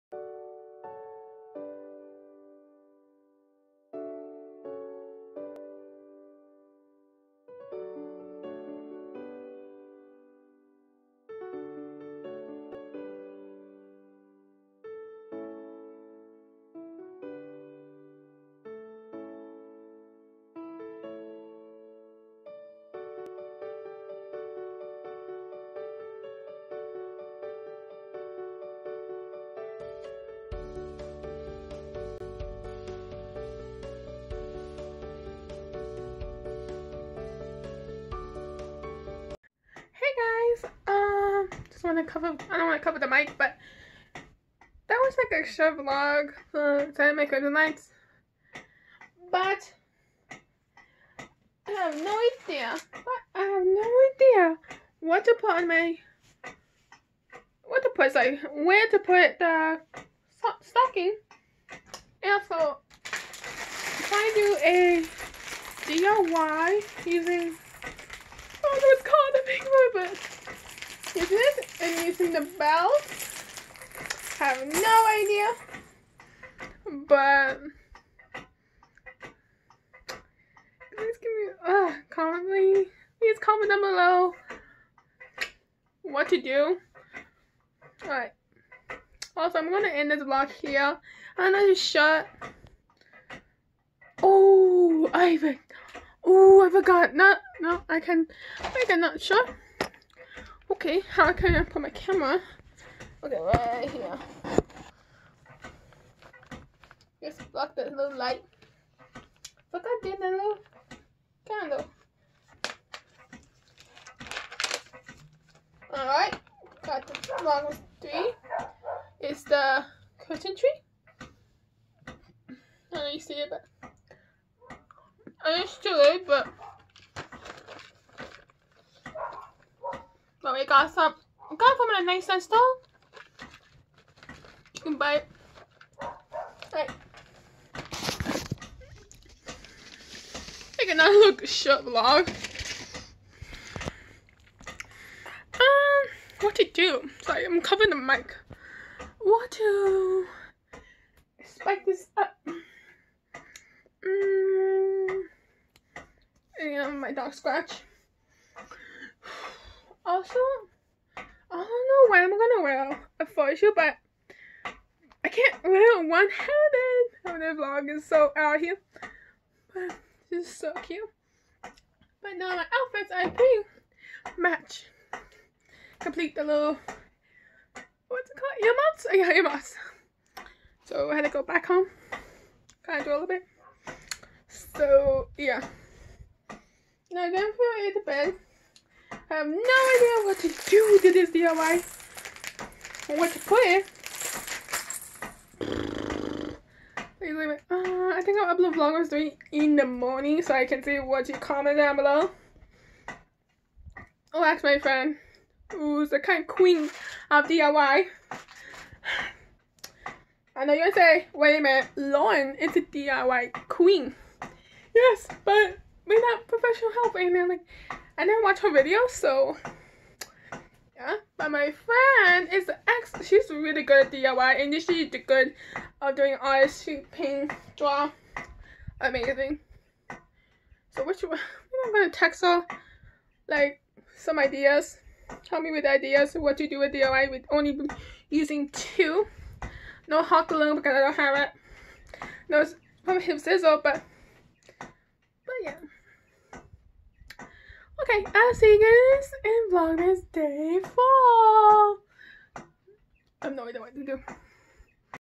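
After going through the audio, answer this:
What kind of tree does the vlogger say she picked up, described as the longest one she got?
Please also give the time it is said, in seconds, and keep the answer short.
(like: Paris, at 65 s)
curtain tree, at 119 s.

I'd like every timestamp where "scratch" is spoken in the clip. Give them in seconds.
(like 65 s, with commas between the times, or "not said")
157 s.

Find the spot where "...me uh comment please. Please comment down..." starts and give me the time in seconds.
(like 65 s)
81 s.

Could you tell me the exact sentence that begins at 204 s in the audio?
Oh, ask my friend who's the kind of queen of DIY.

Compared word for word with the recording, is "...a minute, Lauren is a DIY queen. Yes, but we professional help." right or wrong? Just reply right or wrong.
right.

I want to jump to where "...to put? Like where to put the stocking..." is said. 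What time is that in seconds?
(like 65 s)
57 s.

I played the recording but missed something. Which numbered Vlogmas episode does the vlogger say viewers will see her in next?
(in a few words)
Day 4.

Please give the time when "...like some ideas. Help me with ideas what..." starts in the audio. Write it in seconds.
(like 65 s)
233 s.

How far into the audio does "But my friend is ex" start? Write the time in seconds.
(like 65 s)
221 s.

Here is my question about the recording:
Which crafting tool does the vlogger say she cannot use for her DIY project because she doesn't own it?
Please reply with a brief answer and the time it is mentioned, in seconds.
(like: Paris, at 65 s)
hot glue, at 240 s.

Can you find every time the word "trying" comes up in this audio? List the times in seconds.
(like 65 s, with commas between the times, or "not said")
46 s, 63 s.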